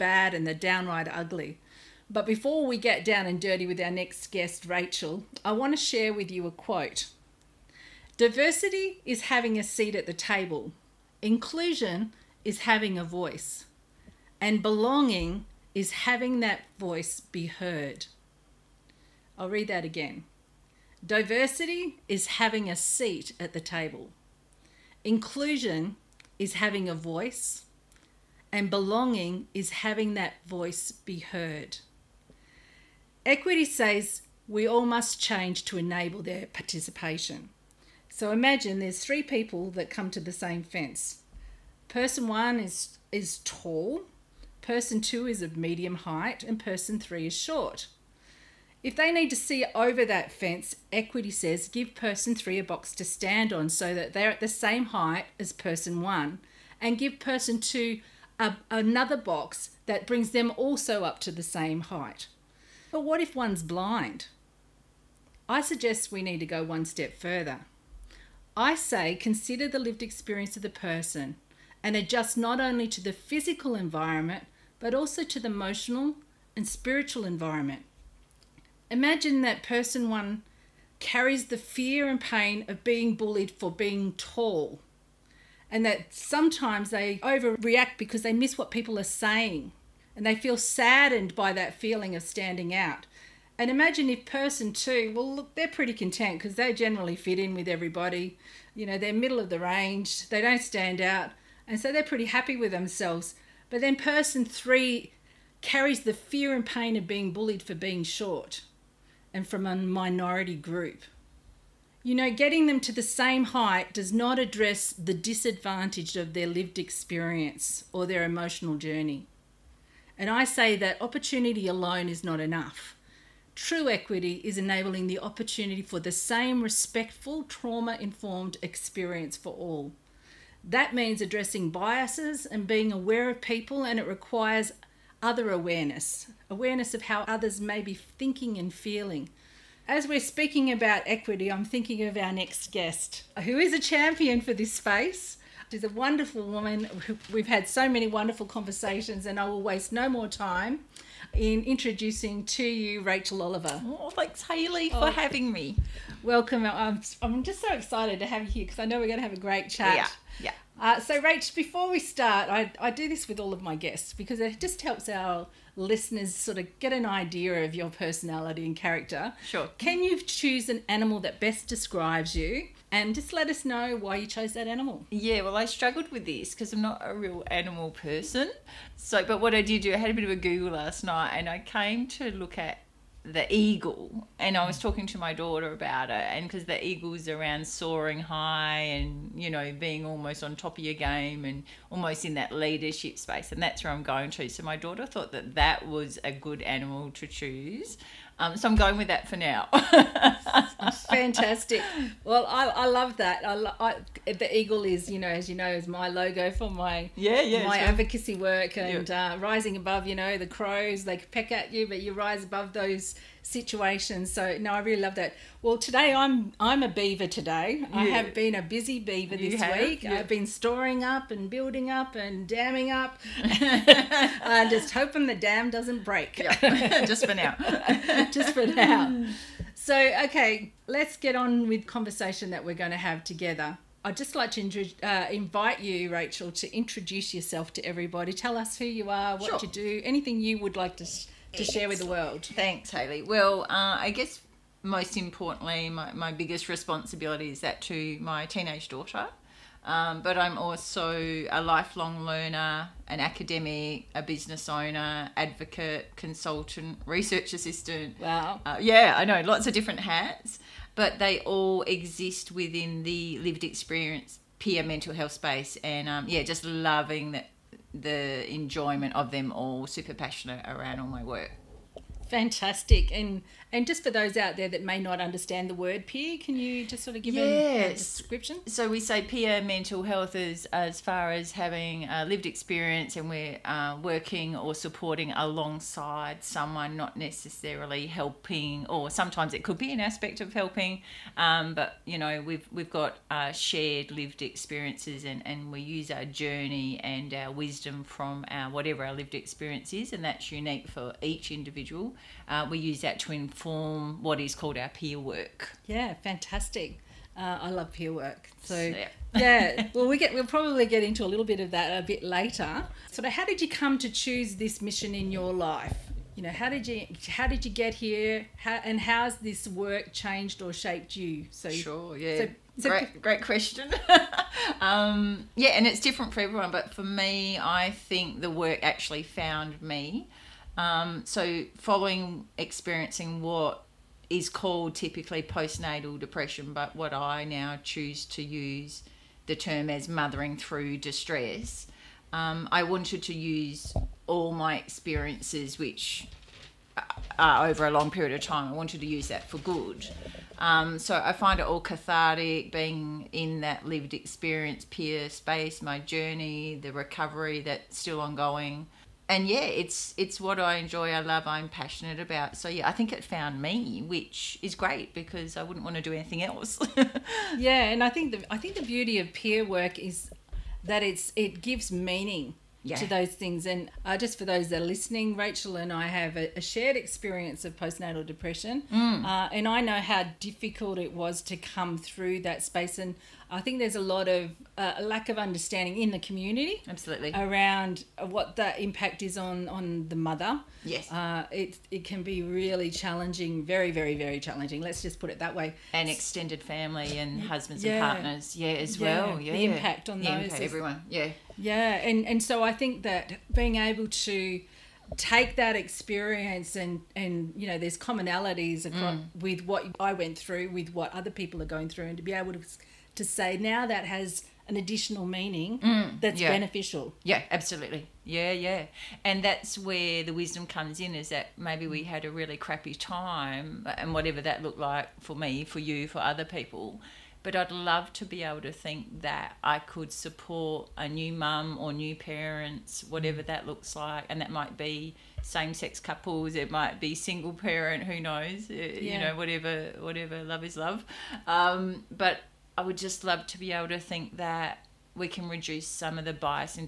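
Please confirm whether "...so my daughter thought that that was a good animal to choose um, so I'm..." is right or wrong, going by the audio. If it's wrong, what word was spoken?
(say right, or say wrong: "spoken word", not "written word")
right.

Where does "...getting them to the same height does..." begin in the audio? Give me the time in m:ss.
1:52.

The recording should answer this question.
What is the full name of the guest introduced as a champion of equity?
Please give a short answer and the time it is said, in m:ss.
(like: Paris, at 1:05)
Rachel Oliver, at 2:33.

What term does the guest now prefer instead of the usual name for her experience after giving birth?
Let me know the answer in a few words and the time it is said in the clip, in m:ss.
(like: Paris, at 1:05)
Mothering through distress, at 5:40.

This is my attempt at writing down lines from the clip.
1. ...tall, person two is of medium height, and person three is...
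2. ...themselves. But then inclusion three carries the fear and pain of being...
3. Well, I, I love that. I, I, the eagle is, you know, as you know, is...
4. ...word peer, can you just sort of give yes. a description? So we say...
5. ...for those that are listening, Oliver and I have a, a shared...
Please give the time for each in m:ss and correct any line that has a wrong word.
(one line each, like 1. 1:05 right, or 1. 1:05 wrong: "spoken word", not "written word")
1. 0:43 right
2. 1:42 wrong: "person", not "inclusion"
3. 3:22 right
4. 4:35 right
5. 6:14 wrong: "Rachel", not "Oliver".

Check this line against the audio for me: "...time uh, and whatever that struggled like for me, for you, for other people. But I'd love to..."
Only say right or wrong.
wrong.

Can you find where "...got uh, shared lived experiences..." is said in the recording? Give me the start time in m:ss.
4:52.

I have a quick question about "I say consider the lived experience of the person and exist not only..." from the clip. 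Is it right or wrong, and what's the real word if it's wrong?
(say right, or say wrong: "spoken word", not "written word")
wrong: "adjust", not "exist".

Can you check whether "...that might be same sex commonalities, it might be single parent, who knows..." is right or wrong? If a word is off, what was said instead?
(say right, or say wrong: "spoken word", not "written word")
wrong: "couples", not "commonalities".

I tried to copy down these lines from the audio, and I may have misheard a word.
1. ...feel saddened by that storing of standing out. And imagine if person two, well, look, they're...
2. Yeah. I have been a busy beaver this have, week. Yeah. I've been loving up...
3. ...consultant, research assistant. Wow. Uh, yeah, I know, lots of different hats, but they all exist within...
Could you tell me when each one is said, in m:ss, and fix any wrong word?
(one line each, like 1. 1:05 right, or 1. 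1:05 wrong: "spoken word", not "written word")
1. 1:30 wrong: "feeling", not "storing"
2. 3:37 wrong: "storing", not "loving"
3. 4:16 right.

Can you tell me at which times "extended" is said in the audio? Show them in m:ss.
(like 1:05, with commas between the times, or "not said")
6:36.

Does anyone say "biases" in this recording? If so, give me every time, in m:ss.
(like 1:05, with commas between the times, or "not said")
2:11.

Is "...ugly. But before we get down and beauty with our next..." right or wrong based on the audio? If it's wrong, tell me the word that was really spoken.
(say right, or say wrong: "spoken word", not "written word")
wrong: "dirty", not "beauty".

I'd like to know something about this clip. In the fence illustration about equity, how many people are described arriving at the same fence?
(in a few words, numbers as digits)
3.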